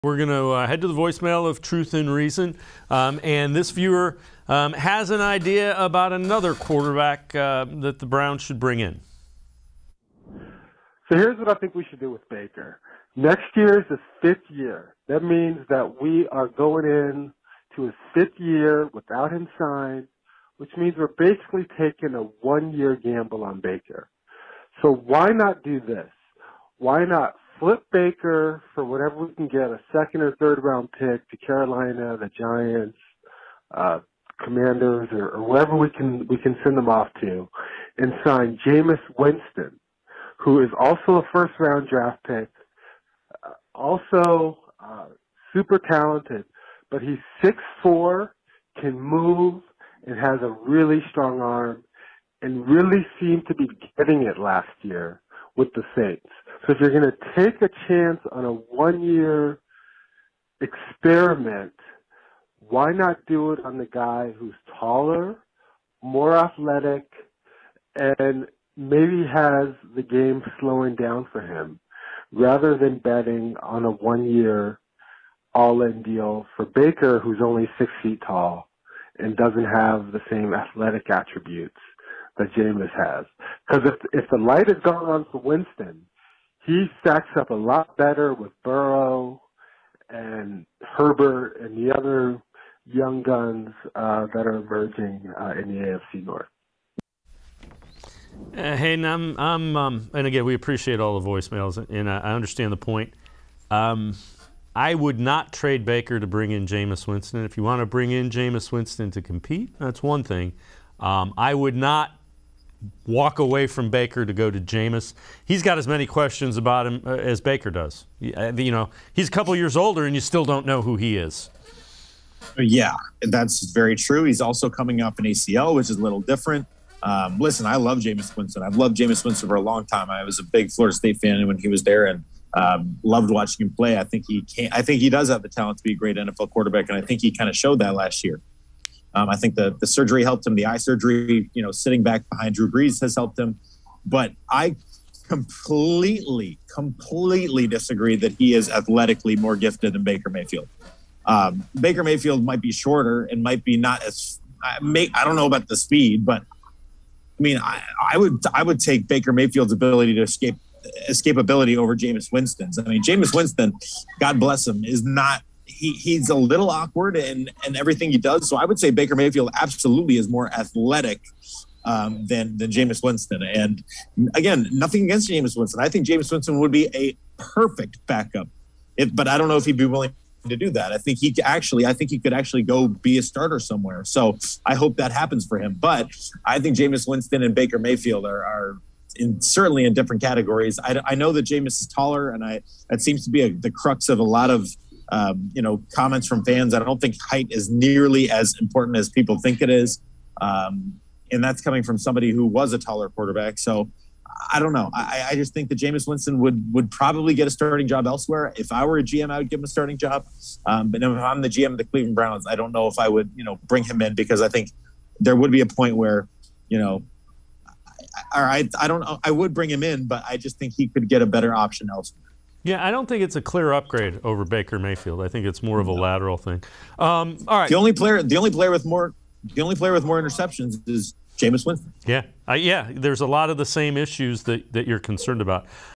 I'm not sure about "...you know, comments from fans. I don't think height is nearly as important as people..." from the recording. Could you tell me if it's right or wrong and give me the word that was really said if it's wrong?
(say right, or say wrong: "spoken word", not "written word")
right.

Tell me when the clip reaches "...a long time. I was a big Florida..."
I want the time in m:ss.
2:09.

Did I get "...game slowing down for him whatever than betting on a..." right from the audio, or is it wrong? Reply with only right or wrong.
wrong.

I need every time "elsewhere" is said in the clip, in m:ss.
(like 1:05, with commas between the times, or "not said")
3:28, 3:41.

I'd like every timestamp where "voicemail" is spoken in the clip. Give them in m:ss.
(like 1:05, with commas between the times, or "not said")
0:00, 1:41.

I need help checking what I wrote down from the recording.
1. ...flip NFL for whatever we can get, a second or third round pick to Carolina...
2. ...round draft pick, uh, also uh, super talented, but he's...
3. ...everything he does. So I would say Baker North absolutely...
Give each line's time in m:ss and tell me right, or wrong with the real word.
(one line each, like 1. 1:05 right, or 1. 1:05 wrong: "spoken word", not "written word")
1. 0:27 wrong: "Baker", not "NFL"
2. 0:41 right
3. 2:47 wrong: "Mayfield", not "North".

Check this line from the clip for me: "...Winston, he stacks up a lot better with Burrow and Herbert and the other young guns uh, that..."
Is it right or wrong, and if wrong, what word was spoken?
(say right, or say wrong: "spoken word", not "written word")
right.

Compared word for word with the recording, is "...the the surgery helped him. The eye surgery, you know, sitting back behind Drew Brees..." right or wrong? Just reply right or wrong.
right.